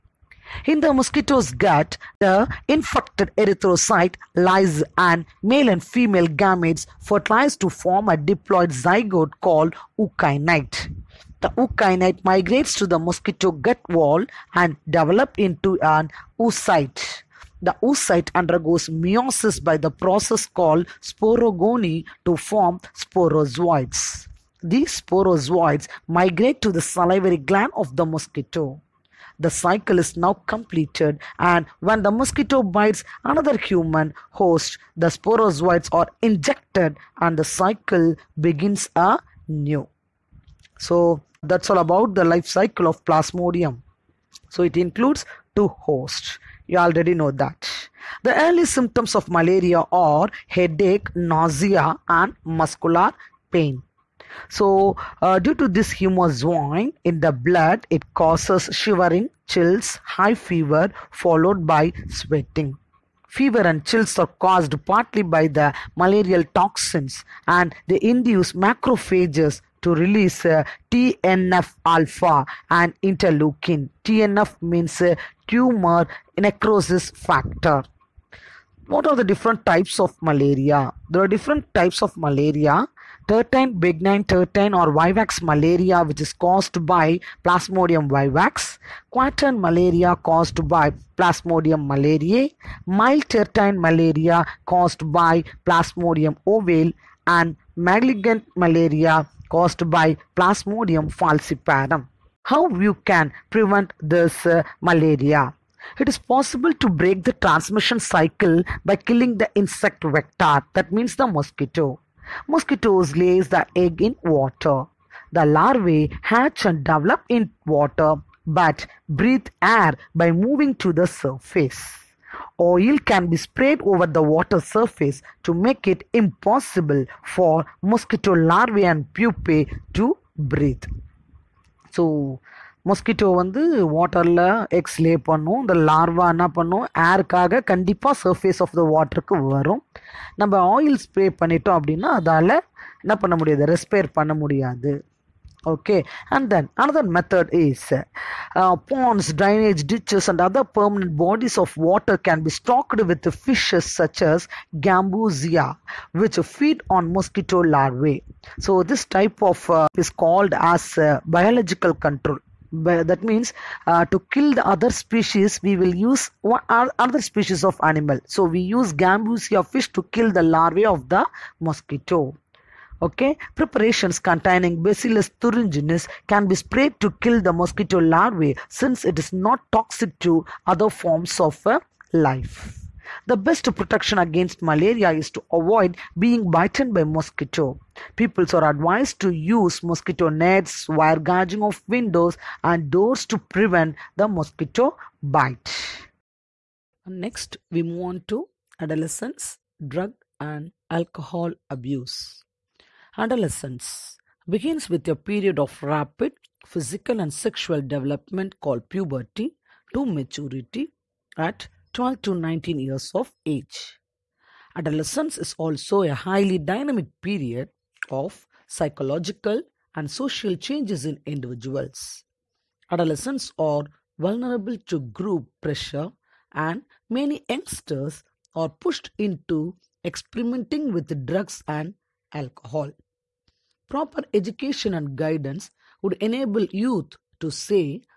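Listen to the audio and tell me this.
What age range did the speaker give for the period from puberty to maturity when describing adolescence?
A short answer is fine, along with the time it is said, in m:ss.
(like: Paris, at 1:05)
12 to 19 years, at 3:31.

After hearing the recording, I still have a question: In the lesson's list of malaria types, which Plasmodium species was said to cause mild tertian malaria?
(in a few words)
Plasmodium ovale.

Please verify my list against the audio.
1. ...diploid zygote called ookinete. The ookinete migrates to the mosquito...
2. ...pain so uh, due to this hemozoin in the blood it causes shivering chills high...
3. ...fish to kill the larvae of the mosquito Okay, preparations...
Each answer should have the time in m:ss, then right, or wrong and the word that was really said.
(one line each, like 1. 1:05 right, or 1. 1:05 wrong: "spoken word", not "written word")
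1. 0:08 right
2. 0:53 right
3. 2:49 right.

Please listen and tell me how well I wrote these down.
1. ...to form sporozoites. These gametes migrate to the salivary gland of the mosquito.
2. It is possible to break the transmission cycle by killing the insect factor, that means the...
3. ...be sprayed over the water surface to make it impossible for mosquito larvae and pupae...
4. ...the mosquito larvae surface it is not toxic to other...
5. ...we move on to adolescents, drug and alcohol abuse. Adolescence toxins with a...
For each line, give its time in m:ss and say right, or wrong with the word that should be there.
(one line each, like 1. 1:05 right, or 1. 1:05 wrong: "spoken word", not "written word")
1. 0:22 wrong: "sporozoites", not "gametes"
2. 1:45 wrong: "vector", not "factor"
3. 2:03 right
4. 2:57 wrong: "since", not "surface"
5. 3:17 wrong: "begins", not "toxins".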